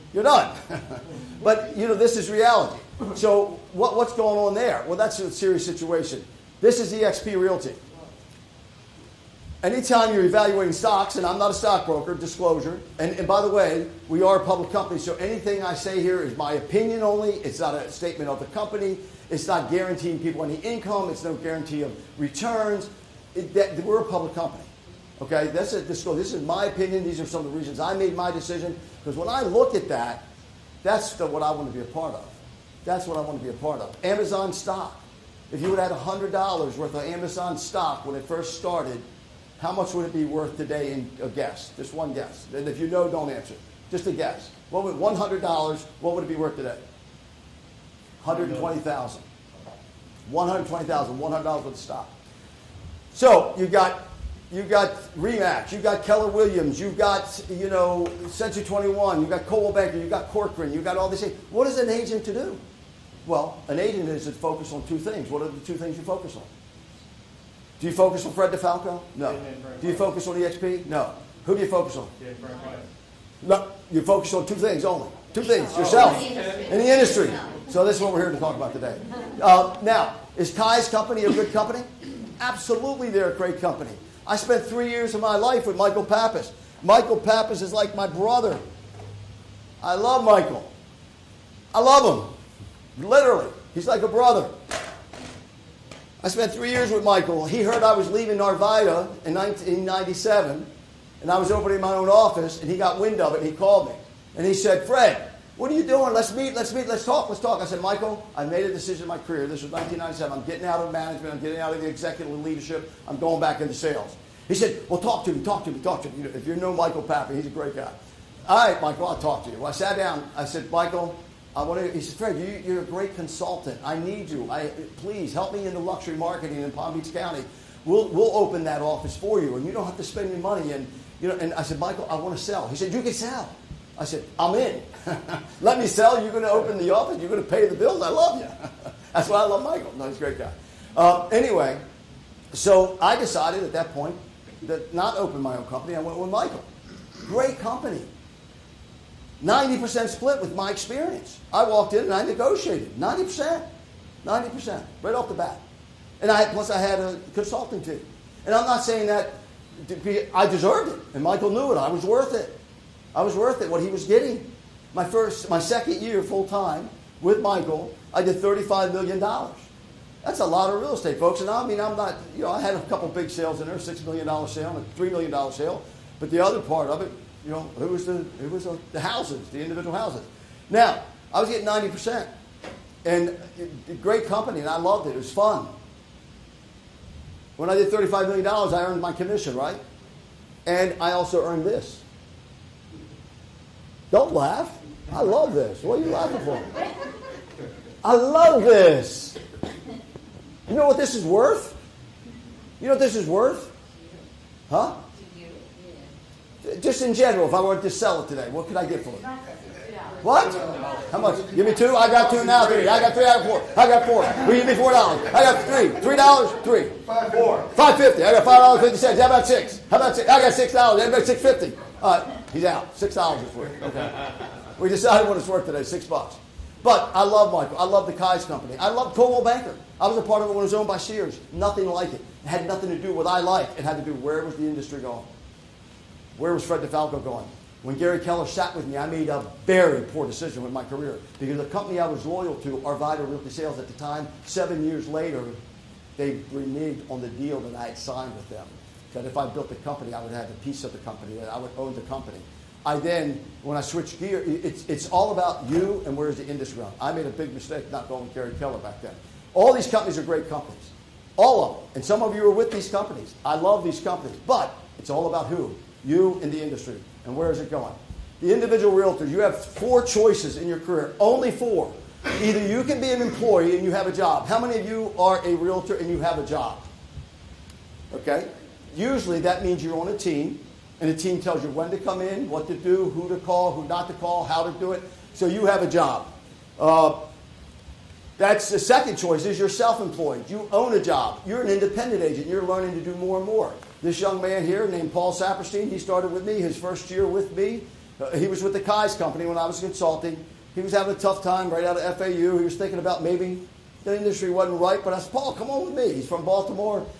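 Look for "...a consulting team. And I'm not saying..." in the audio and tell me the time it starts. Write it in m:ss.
2:36.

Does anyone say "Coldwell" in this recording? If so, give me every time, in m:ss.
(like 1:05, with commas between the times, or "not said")
0:59, 3:49.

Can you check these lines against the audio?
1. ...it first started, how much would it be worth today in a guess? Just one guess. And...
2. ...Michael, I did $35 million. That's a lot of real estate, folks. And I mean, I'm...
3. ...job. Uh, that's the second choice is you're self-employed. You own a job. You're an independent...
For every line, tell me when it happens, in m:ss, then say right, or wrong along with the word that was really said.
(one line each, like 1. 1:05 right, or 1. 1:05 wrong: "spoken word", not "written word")
1. 0:38 right
2. 2:47 right
3. 4:45 right.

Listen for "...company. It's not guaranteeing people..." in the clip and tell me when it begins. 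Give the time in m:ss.
0:18.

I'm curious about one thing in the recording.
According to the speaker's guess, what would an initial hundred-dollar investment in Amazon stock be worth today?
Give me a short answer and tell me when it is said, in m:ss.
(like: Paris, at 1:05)
$120,000, at 0:50.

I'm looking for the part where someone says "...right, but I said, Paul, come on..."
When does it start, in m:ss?
5:04.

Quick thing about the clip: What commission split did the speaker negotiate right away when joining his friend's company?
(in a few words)
90%.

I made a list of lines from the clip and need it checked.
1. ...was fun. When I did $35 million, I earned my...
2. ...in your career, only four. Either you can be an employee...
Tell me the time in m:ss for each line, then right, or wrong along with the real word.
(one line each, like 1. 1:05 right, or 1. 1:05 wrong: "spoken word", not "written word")
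1. 3:05 right
2. 4:30 right.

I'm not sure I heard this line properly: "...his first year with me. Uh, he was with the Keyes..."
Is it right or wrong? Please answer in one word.
right.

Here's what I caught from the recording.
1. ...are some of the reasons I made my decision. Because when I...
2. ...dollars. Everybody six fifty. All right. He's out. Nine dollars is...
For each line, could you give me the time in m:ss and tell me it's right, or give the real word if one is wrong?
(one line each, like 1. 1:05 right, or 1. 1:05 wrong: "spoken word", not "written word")
1. 0:27 right
2. 3:40 wrong: "Six", not "Nine".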